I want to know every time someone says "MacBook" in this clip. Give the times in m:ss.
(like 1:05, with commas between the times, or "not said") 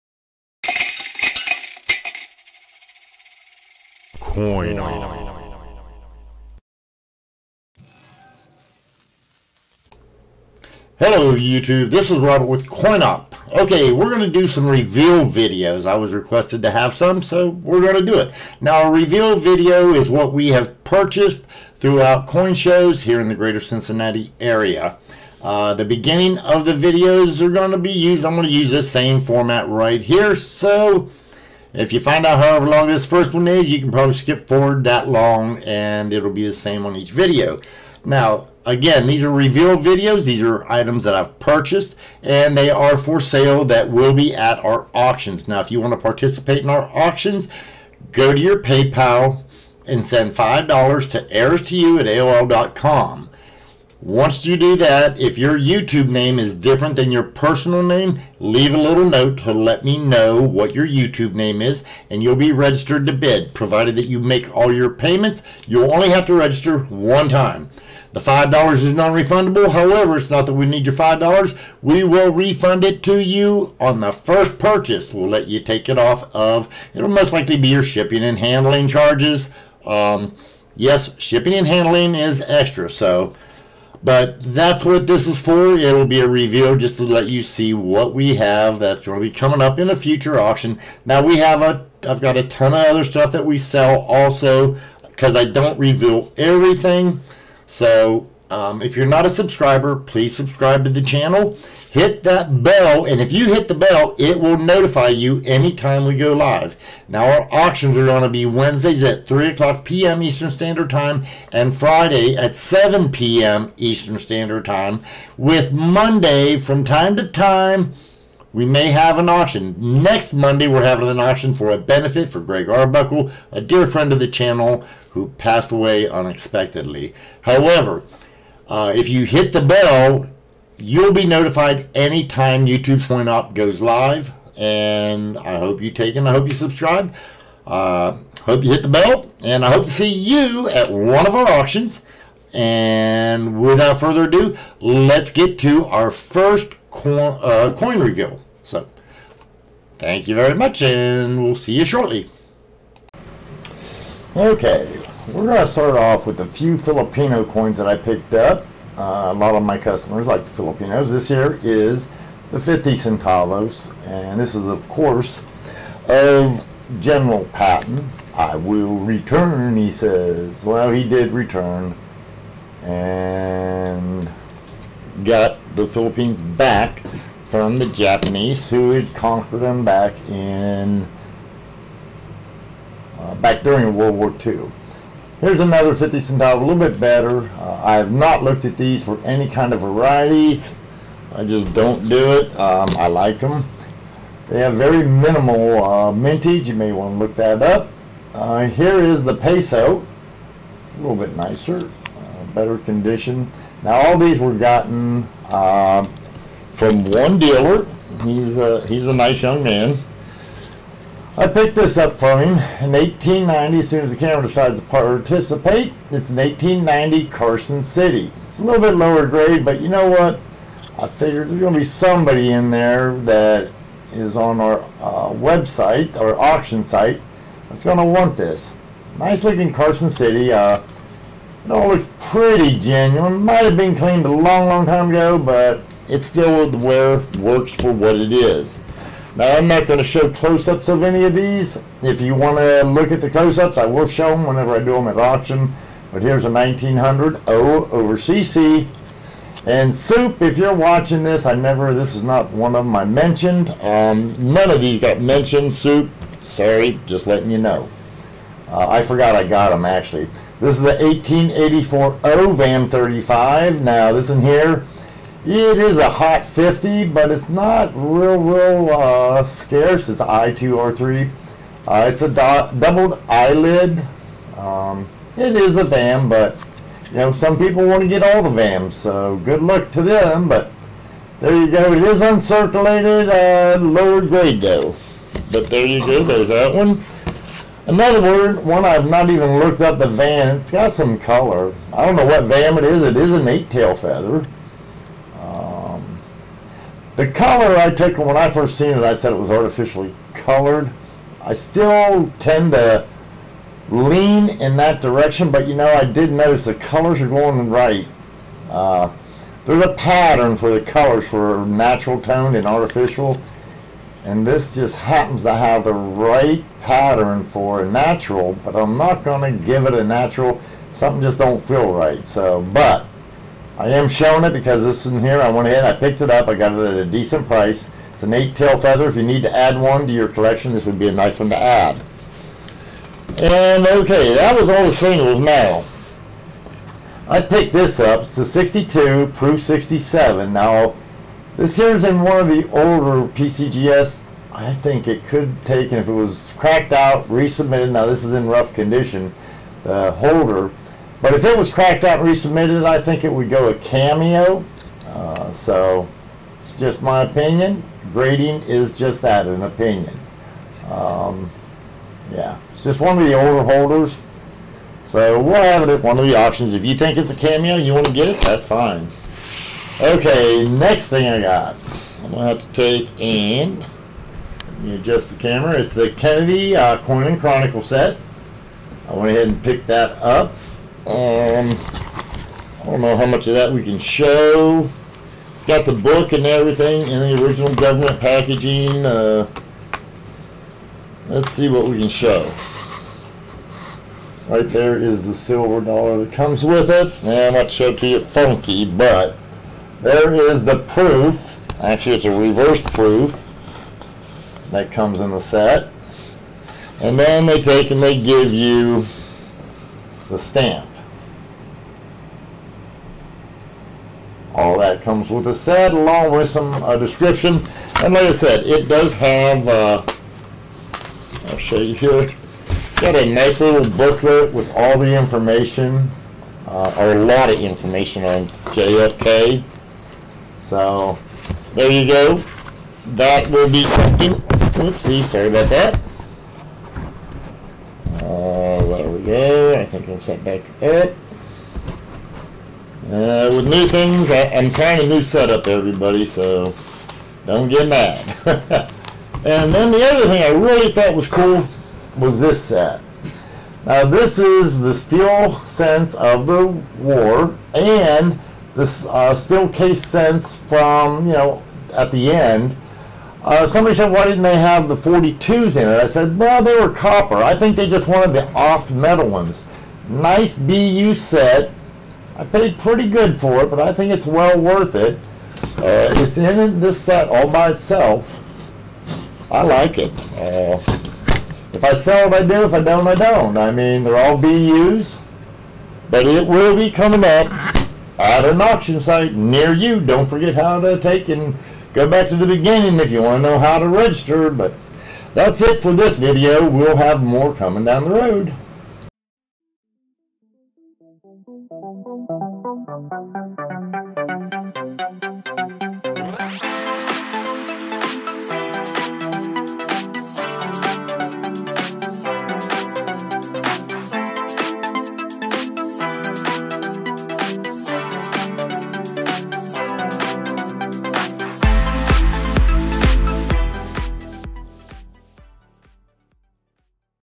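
not said.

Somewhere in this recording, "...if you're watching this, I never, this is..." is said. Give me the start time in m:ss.
4:10.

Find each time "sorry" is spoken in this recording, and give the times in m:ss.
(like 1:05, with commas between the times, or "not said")
4:16, 7:15.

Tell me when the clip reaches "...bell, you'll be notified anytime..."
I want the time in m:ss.
2:09.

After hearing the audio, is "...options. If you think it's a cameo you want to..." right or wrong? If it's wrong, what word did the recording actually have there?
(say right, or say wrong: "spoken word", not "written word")
right.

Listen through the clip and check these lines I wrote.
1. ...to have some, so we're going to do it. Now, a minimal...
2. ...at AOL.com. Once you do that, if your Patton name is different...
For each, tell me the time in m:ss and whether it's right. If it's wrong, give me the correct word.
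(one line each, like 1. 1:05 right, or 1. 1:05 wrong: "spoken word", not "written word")
1. 0:16 wrong: "reveal", not "minimal"
2. 0:51 wrong: "YouTube", not "Patton".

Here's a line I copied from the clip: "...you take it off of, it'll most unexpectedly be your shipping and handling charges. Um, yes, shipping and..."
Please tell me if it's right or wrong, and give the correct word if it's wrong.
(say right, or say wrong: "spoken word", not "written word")
wrong: "likely", not "unexpectedly".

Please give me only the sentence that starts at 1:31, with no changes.
Now we have a, I've got a ton of other stuff that we sell also because I don't reveal everything.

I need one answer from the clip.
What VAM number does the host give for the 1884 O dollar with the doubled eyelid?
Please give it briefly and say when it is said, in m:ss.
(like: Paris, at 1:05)
VAM 35, at 4:22.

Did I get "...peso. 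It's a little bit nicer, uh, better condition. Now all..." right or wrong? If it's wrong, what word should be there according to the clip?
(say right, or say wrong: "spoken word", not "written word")
right.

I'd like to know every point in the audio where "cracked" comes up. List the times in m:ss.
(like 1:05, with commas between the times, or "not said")
5:46, 5:51.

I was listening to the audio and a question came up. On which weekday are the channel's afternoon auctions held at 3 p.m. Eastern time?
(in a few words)
Wednesdays.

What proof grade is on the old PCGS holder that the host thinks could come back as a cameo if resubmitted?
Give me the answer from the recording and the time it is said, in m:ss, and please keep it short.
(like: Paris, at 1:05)
Proof 67, at 5:39.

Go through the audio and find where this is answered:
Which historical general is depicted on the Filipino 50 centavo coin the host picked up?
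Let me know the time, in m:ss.
2:46.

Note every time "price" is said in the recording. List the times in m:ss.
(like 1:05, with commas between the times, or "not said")
5:27.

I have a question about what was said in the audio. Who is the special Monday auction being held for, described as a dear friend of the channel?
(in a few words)
Greg Arbuckle.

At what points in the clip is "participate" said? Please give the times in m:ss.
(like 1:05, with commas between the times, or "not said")
0:45, 3:34.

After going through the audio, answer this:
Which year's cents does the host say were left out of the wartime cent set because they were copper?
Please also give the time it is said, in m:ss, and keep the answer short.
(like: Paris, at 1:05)
1942, at 7:44.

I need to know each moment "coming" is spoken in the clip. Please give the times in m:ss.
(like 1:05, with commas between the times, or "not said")
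1:29, 8:06, 8:17.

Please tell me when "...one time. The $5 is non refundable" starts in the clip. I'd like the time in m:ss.
1:06.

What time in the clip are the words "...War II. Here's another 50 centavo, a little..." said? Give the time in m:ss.
3:04.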